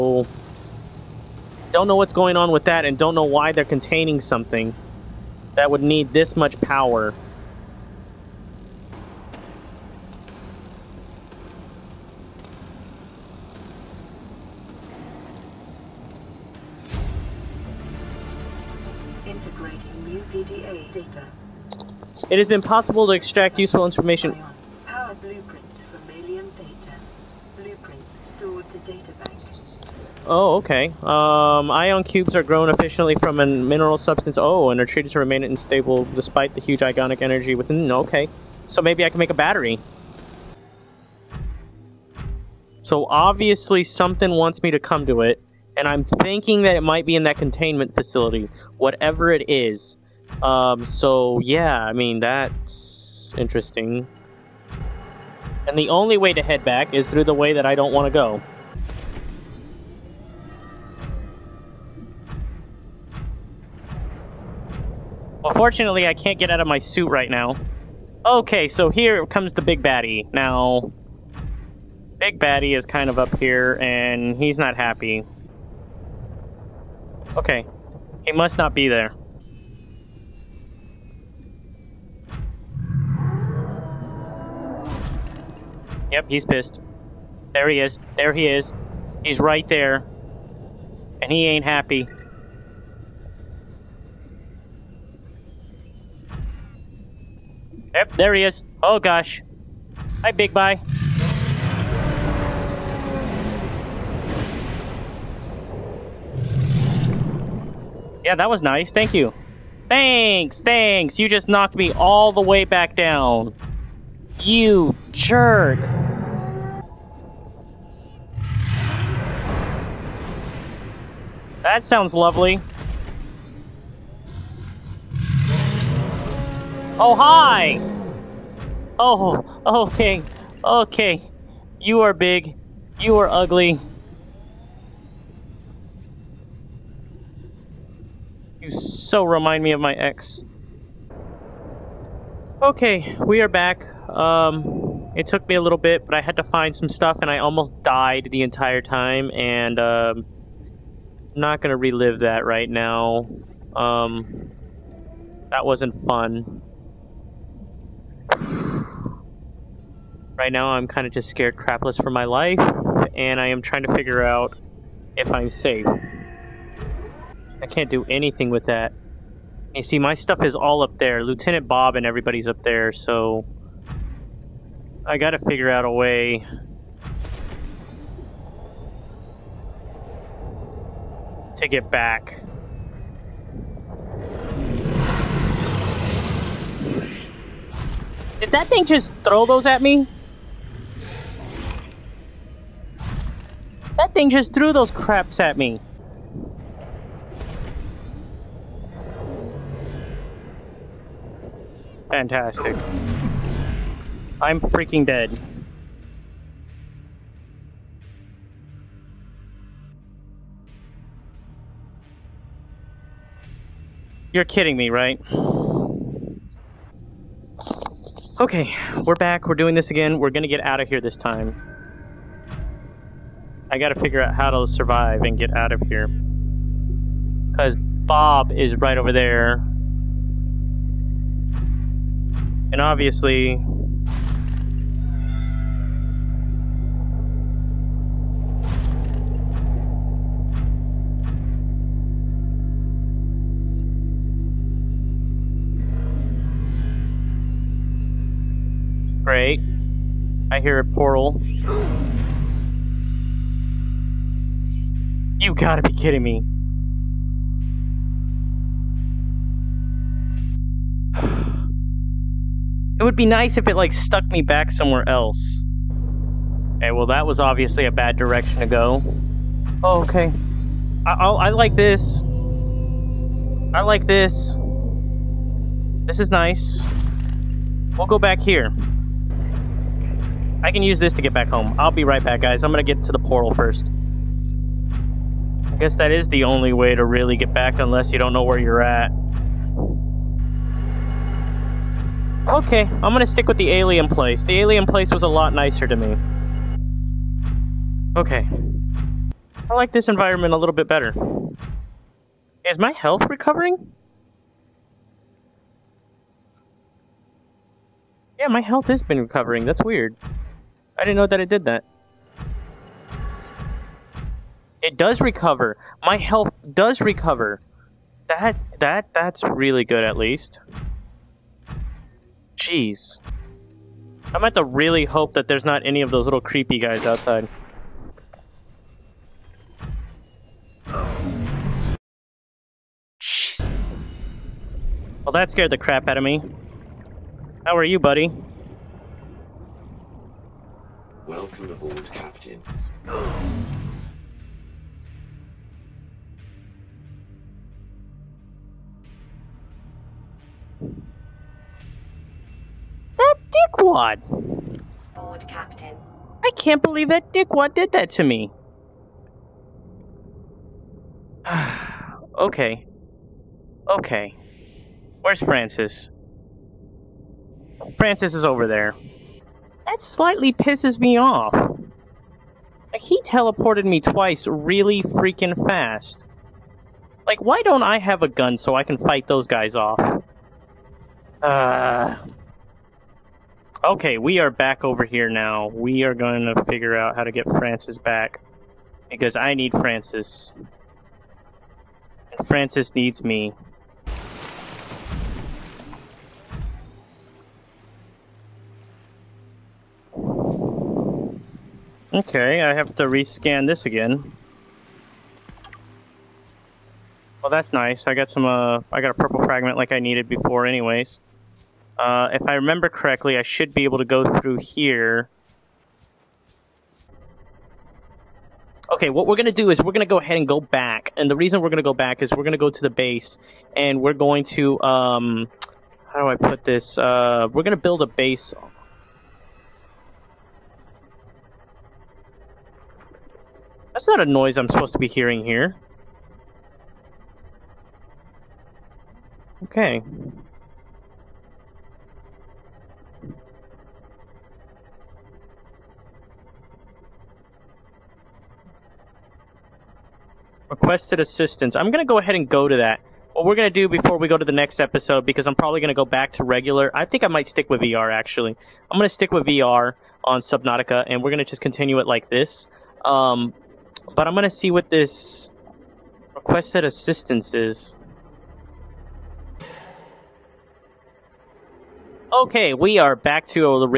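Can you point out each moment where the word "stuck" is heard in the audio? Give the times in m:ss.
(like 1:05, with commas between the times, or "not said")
4:23.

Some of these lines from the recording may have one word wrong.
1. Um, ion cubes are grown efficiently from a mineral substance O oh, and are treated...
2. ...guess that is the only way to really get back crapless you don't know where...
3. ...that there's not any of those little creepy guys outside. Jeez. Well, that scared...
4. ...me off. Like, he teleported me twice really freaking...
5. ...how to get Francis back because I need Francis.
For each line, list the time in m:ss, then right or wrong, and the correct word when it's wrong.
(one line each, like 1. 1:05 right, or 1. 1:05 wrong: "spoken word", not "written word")
1. 0:31 right
2. 4:45 wrong: "unless", not "crapless"
3. 5:25 right
4. 6:11 right
5. 6:27 right.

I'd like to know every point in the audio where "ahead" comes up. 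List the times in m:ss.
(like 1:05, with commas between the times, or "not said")
7:00, 7:32.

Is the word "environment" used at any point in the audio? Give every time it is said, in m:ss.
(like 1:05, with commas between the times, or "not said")
5:00.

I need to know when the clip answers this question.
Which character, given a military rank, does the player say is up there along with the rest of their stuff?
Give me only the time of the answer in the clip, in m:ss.
2:51.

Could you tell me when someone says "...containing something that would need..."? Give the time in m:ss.
0:03.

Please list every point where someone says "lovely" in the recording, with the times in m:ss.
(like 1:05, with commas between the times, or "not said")
2:02.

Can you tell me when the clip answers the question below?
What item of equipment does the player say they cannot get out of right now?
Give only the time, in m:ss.
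1:06.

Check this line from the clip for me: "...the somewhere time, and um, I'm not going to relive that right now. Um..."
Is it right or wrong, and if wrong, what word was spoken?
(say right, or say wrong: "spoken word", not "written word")
wrong: "entire", not "somewhere".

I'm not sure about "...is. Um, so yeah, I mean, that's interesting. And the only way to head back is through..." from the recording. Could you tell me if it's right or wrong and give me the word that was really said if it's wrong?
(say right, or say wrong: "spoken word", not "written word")
right.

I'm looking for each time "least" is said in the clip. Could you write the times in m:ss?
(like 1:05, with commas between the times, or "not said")
5:20.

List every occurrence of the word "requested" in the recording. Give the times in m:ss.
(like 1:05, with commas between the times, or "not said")
7:30, 7:46.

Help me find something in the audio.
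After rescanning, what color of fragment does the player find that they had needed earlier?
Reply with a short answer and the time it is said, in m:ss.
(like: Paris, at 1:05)
Purple, at 6:49.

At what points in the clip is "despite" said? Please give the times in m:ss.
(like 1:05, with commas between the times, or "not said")
0:36.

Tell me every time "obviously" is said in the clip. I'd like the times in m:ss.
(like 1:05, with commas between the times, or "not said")
0:43, 3:52, 4:27.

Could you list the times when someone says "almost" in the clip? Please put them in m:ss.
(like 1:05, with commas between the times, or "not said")
2:27.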